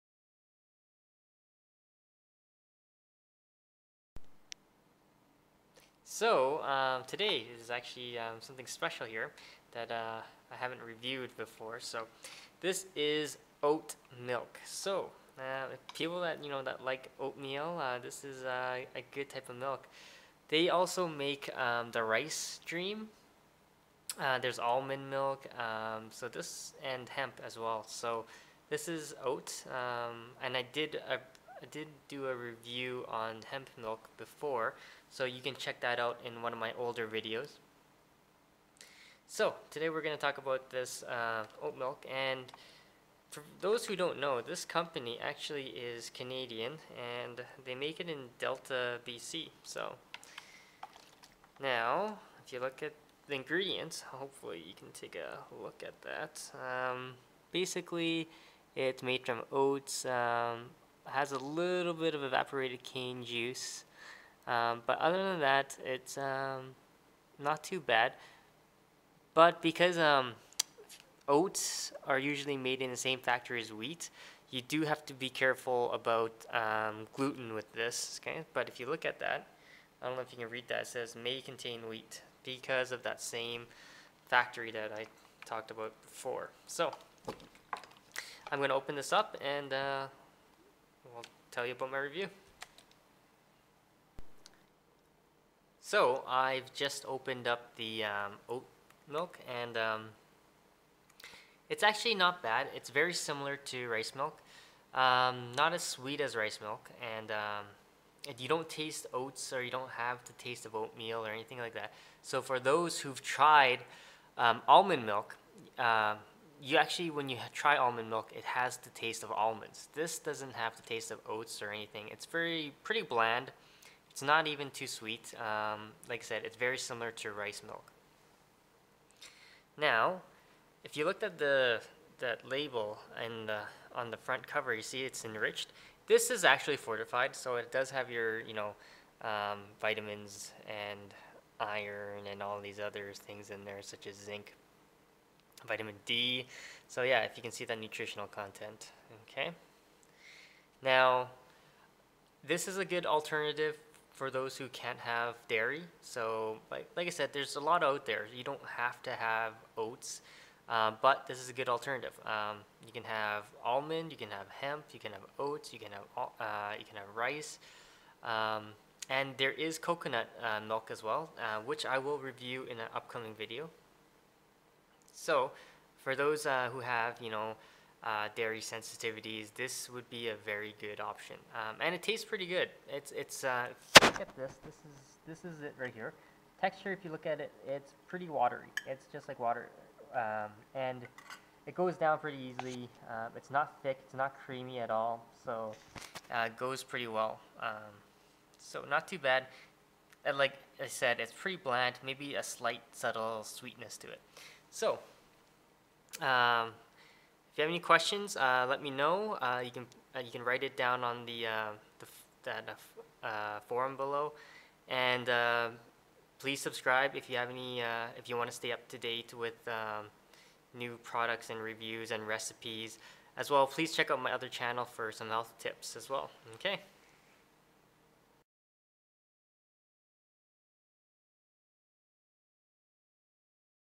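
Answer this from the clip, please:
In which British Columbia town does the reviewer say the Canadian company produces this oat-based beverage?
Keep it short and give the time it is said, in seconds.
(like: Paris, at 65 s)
Delta, at 48 s.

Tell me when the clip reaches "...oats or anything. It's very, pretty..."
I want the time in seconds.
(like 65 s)
121 s.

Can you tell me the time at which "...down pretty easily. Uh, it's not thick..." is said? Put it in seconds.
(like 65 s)
191 s.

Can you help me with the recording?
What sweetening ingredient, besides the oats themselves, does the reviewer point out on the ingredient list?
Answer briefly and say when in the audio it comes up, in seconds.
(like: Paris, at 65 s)
evaporated cane juice, at 62 s.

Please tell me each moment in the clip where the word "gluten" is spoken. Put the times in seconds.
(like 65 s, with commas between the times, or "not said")
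77 s.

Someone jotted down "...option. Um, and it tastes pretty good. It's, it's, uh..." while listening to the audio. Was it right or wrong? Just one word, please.
right.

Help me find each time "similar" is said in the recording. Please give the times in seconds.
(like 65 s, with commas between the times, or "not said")
103 s, 126 s.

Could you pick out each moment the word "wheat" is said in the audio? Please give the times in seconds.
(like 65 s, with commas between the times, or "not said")
73 s, 81 s.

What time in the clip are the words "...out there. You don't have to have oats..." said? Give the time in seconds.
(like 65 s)
157 s.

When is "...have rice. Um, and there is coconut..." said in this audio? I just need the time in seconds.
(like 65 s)
166 s.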